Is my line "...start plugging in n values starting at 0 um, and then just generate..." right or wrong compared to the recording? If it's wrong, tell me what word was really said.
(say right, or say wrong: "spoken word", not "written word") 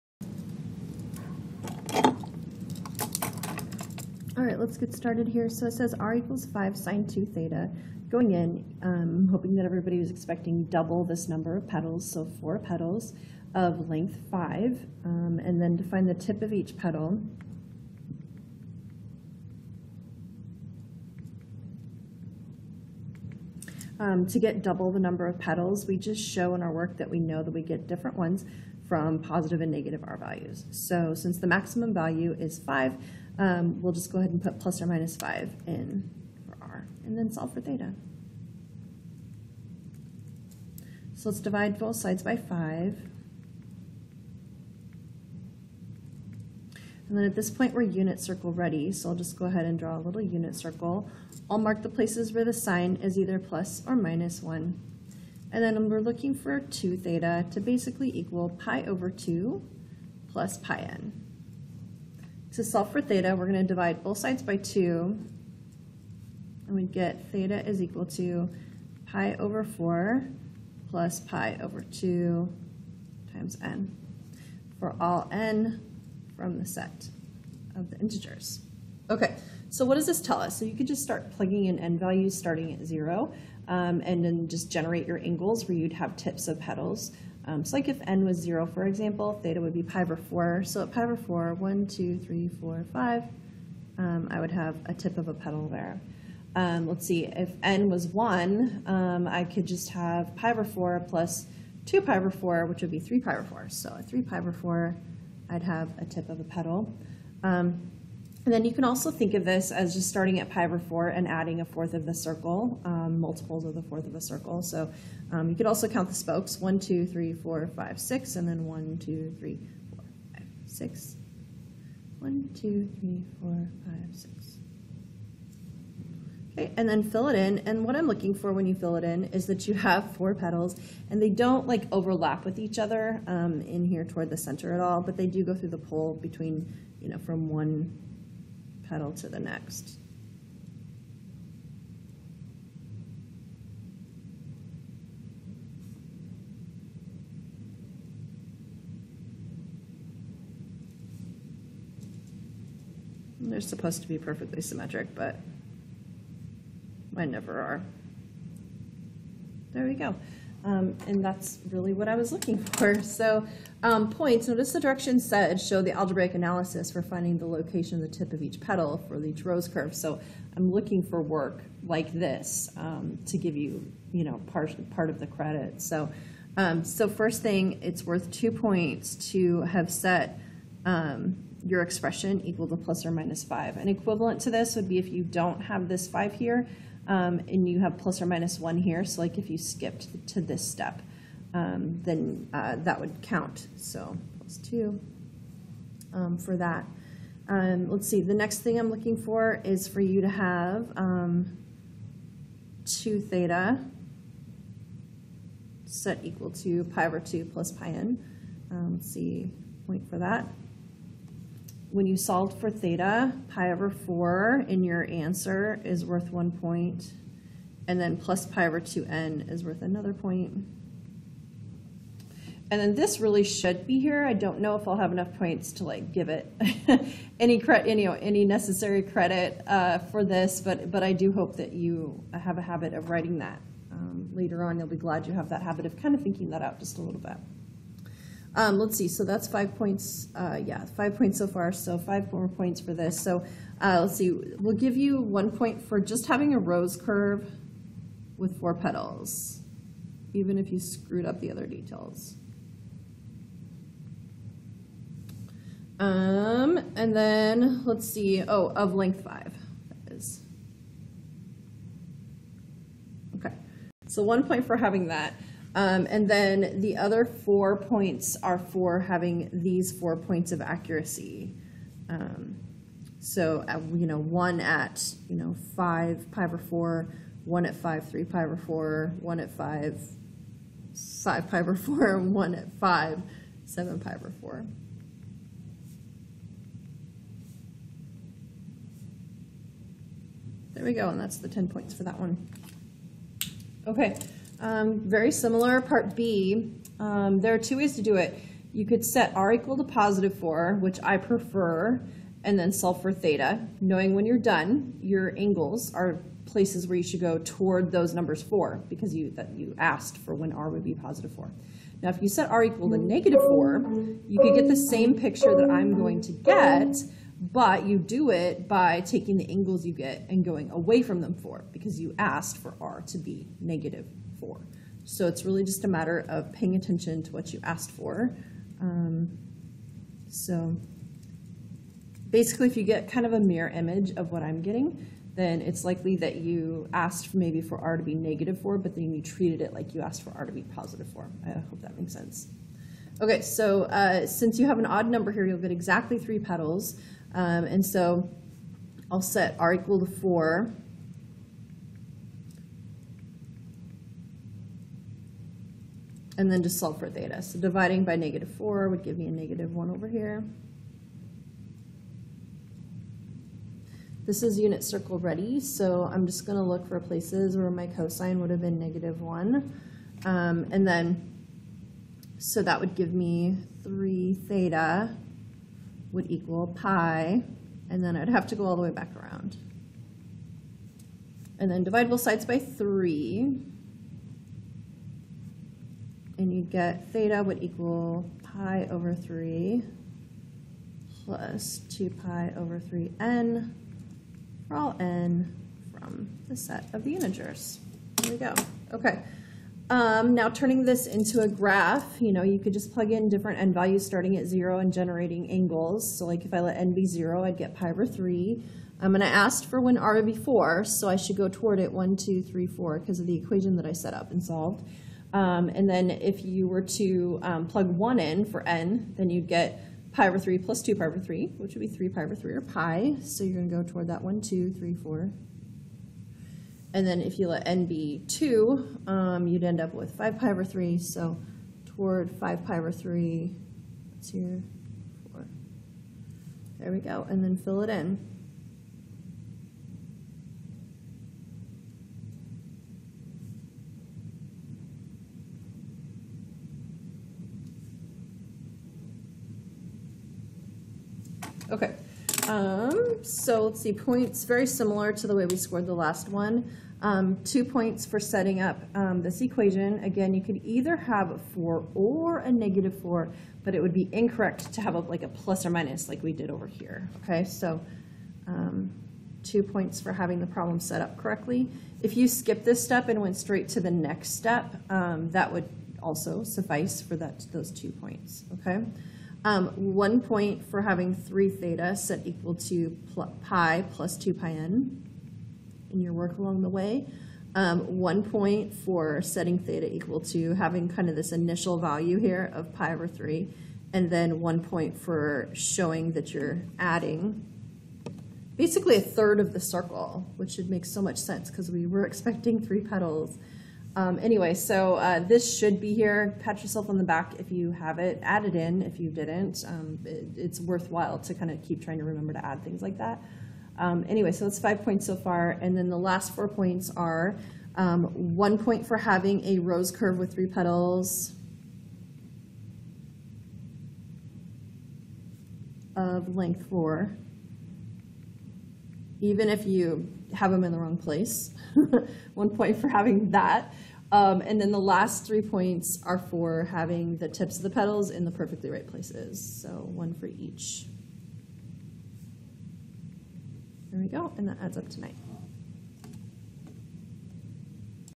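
right.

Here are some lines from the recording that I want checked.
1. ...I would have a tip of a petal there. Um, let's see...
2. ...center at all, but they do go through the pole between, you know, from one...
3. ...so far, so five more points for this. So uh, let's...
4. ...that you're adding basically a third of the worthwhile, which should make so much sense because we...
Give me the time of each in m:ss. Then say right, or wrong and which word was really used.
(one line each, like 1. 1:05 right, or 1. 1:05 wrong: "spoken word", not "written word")
1. 1:34 right
2. 2:14 right
3. 4:01 right
4. 8:16 wrong: "circle", not "worthwhile".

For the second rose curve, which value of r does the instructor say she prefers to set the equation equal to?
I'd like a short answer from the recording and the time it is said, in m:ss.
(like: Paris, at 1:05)
positive 4, at 4:59.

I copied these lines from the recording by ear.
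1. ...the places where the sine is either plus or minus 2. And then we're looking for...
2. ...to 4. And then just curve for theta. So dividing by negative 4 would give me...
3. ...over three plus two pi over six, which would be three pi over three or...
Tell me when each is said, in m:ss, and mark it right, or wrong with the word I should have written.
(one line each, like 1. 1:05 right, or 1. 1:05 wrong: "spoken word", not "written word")
1. 0:51 wrong: "1", not "2"
2. 5:49 wrong: "solve", not "curve"
3. 7:00 wrong: "three", not "six".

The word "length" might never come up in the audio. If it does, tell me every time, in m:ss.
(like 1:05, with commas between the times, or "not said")
0:13, 4:18, 8:46.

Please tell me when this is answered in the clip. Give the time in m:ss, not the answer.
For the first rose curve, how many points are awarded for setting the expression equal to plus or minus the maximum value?
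2:57.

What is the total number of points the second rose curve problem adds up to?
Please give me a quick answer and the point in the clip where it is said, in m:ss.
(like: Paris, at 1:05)
9, at 9:04.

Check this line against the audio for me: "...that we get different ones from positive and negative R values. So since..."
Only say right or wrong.
right.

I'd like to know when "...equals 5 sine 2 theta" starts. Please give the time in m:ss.
0:06.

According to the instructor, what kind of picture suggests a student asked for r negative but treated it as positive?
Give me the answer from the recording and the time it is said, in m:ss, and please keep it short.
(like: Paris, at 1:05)
mirror image, at 5:33.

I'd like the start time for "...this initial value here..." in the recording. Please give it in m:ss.
8:11.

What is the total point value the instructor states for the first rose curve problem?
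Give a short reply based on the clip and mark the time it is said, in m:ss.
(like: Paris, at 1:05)
10, at 4:51.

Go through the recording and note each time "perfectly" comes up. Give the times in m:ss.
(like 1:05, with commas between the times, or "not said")
2:34, 8:58.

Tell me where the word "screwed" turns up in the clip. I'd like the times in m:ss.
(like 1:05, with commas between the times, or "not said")
4:10.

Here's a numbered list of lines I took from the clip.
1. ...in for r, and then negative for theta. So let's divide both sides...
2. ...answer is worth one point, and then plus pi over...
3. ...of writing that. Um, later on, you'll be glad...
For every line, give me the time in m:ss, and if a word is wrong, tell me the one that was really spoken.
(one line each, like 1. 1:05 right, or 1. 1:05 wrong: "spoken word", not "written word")
1. 0:35 wrong: "solve", not "negative"
2. 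3:35 right
3. 3:52 right.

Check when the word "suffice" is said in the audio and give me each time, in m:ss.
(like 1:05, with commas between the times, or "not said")
7:56.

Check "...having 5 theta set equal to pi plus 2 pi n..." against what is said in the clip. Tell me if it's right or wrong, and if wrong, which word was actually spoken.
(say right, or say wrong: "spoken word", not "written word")
wrong: "3", not "5".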